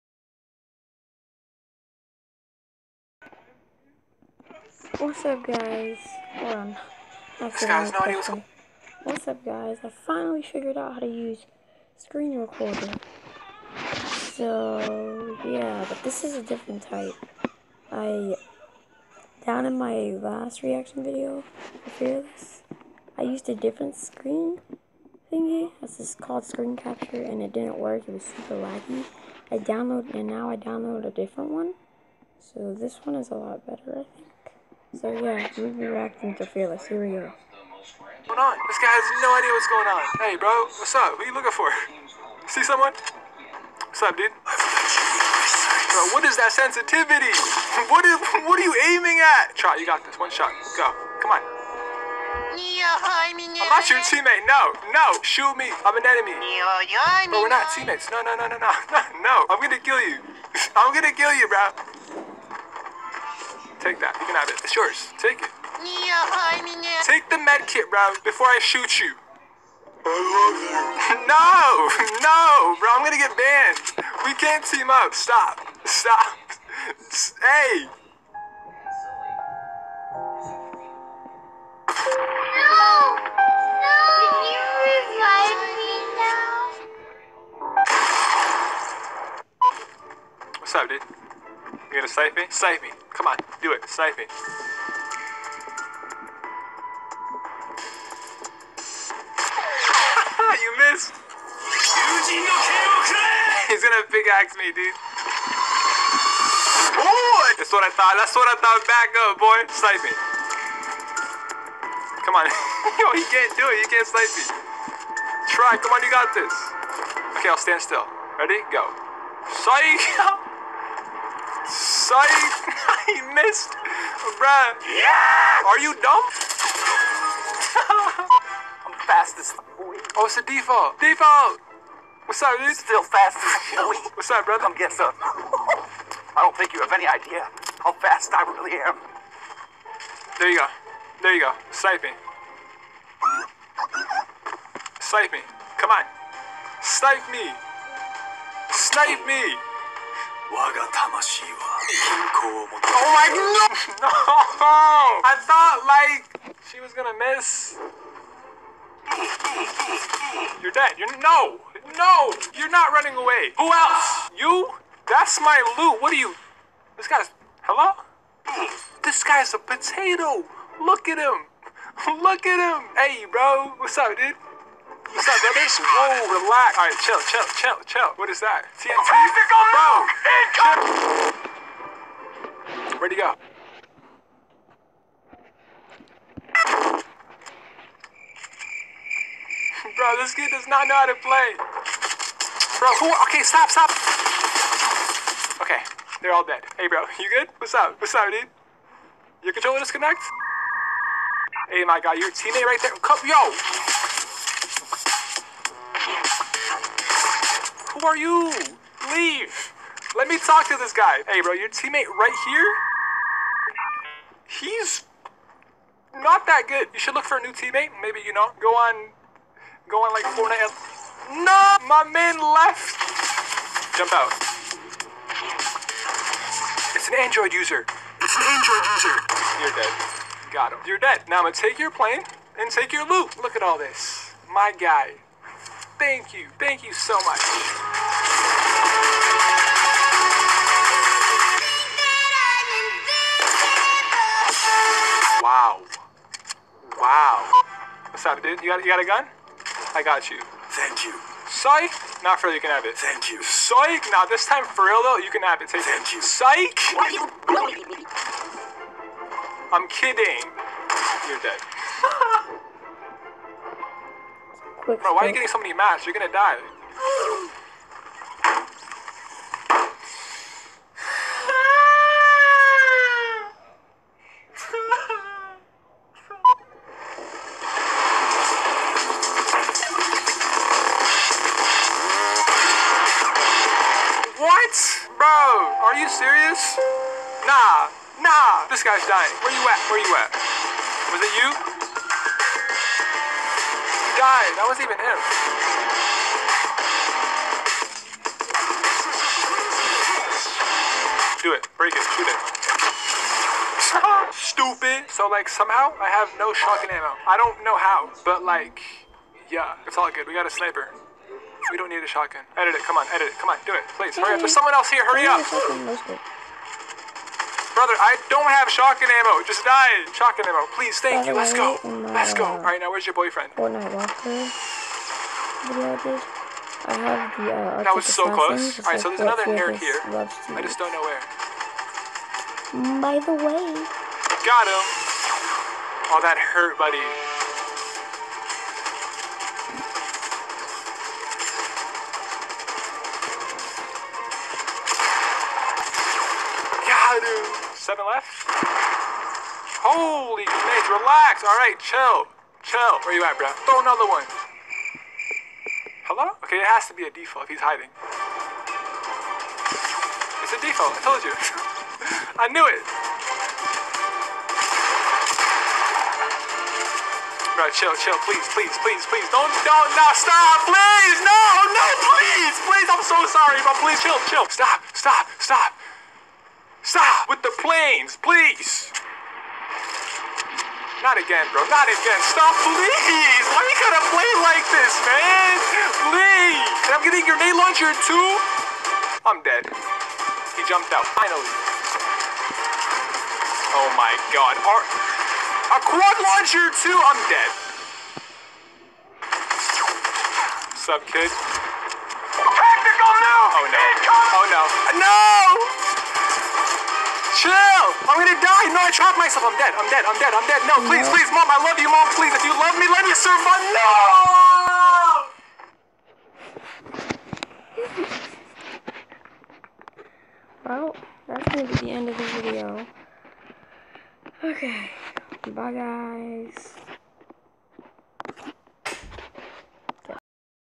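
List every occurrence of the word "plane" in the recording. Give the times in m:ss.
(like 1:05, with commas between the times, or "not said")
3:51, 6:17.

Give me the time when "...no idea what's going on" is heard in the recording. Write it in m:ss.
0:39.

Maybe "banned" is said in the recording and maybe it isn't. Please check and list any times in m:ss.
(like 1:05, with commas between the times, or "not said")
1:13.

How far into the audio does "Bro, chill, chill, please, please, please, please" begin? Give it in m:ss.
6:07.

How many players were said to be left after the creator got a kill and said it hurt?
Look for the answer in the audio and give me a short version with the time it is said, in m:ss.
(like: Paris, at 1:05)
7, at 5:47.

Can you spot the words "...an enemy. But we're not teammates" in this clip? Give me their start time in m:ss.
0:55.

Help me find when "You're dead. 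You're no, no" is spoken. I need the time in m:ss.
2:40.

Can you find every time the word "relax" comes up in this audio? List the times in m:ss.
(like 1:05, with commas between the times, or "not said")
2:56, 5:50.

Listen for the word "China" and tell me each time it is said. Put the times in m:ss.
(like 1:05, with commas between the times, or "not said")
not said.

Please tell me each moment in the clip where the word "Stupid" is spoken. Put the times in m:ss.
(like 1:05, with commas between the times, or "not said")
5:04.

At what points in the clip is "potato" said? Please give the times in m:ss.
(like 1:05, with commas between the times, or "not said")
2:49.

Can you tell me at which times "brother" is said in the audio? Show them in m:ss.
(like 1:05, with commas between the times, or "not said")
2:14, 5:17.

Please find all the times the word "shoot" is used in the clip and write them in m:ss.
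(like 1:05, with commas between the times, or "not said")
0:55, 1:08, 5:02.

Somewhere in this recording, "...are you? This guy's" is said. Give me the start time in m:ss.
2:46.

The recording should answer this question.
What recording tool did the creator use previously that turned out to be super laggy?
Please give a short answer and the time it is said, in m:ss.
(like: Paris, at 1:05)
Screen capture, at 0:26.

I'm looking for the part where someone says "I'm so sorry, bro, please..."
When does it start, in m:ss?
6:12.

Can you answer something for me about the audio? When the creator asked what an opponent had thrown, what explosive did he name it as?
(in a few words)
TNT.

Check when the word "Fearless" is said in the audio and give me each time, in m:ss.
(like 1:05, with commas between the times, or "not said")
0:21, 0:36.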